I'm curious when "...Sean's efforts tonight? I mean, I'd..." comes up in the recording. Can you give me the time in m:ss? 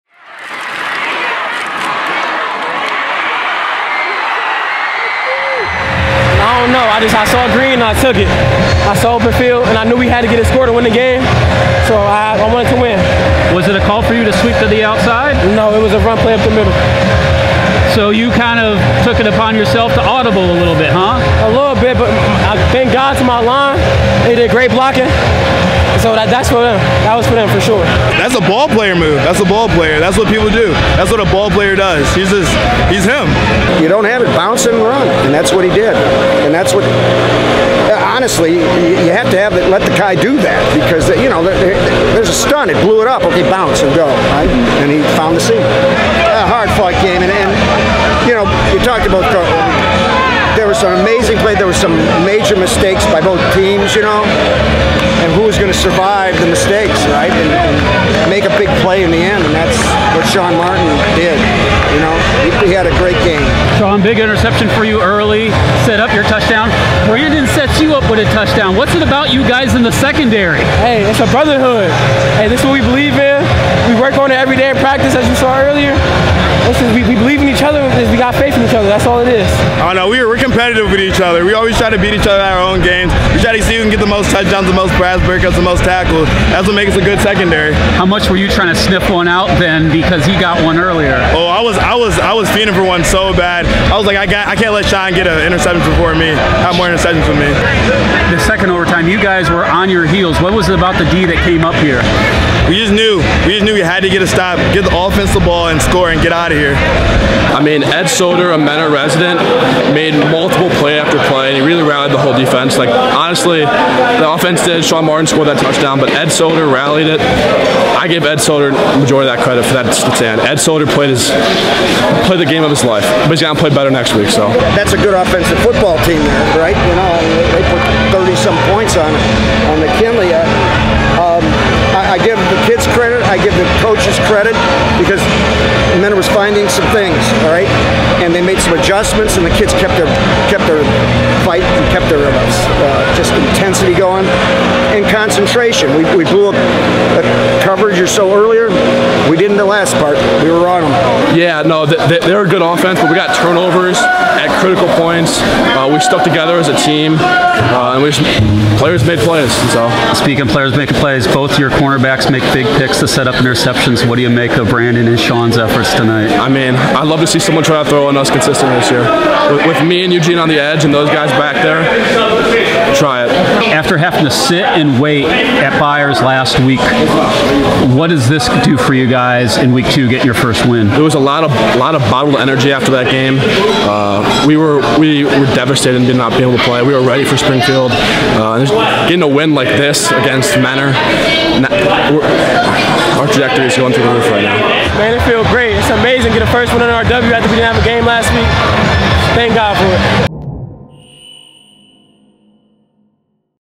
2:45.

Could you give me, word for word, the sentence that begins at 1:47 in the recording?
I mean, Ed Soder, a Mena resident, made multiple play after play, and he really rallied the whole defense.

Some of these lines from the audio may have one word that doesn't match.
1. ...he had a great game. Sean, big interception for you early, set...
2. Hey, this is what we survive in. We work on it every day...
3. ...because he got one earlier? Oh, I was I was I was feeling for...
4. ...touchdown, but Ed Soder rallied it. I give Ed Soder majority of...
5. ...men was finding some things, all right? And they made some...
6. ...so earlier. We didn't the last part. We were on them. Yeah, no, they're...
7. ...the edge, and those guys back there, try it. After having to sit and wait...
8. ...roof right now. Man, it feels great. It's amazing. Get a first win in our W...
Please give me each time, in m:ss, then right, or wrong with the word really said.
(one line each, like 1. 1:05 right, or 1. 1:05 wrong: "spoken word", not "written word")
1. 1:02 right
2. 1:12 wrong: "believe", not "survive"
3. 1:29 right
4. 1:55 right
5. 2:16 right
6. 2:28 right
7. 2:50 right
8. 3:14 right.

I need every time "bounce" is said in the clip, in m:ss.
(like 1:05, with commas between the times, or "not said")
0:34, 0:43.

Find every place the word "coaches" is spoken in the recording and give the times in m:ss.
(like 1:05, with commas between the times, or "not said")
2:13.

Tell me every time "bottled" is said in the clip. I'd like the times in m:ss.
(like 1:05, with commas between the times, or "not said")
3:02.